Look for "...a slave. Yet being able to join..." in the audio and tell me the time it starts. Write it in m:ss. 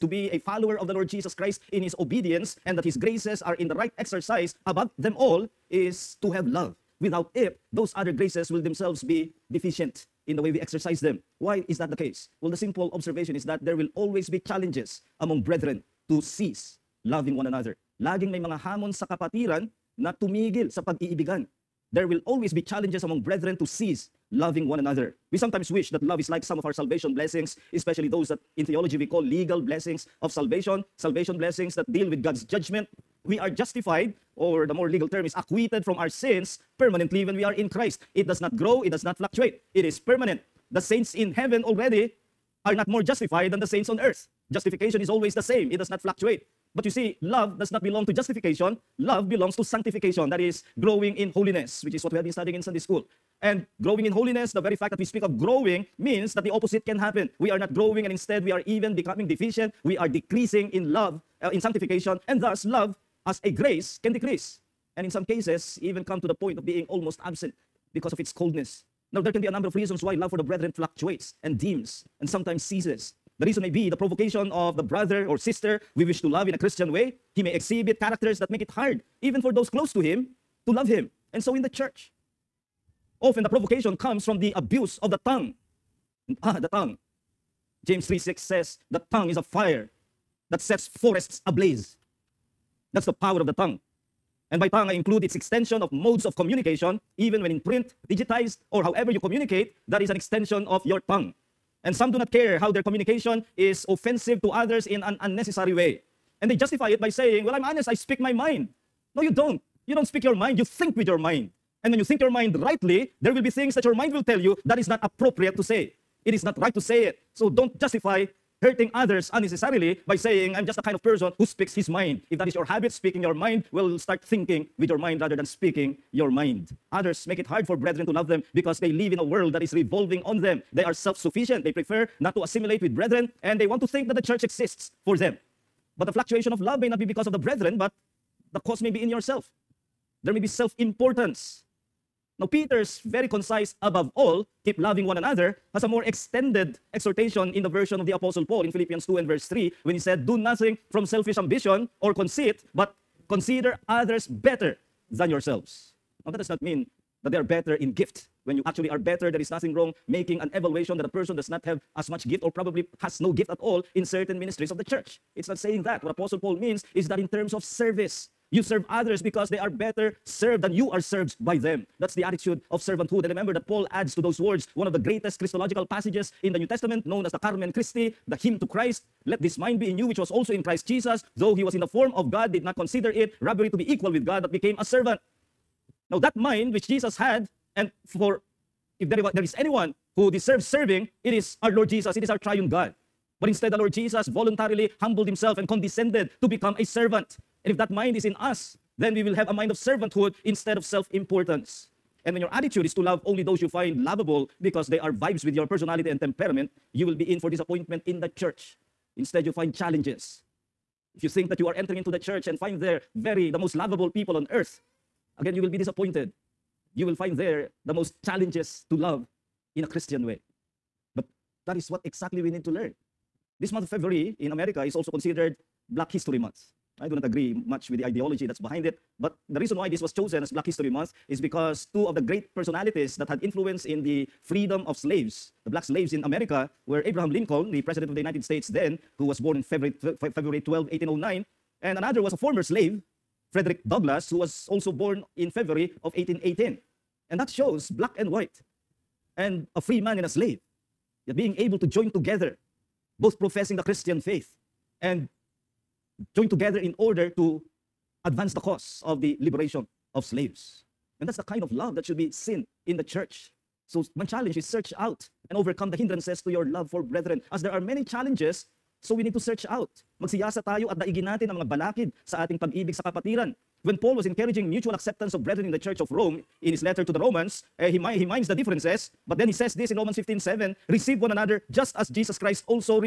4:10.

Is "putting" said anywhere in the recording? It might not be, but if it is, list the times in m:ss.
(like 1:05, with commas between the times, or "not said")
not said.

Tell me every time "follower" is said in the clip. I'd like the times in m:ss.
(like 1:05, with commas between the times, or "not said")
0:00.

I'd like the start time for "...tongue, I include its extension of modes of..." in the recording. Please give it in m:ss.
1:34.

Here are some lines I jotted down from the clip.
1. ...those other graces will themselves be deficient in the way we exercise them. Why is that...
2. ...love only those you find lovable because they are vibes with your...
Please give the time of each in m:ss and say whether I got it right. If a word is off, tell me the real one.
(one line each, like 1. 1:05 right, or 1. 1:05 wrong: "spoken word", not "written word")
1. 0:07 right
2. 3:23 right.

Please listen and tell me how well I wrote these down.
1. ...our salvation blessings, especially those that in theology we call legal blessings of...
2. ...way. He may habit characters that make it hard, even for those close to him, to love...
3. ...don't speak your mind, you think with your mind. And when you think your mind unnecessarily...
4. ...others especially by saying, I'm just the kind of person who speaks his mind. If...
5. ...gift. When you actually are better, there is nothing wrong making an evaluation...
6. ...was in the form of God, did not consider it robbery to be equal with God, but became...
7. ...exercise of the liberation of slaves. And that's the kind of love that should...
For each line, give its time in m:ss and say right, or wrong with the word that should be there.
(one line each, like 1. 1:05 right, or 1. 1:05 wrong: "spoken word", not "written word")
1. 0:26 right
2. 1:16 wrong: "exhibit", not "habit"
3. 1:49 wrong: "rightly", not "unnecessarily"
4. 1:58 wrong: "unnecessarily", not "especially"
5. 2:37 right
6. 3:01 right
7. 4:18 wrong: "cause", not "exercise".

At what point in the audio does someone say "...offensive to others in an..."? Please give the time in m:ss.
1:43.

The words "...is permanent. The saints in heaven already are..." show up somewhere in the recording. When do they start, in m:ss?
0:39.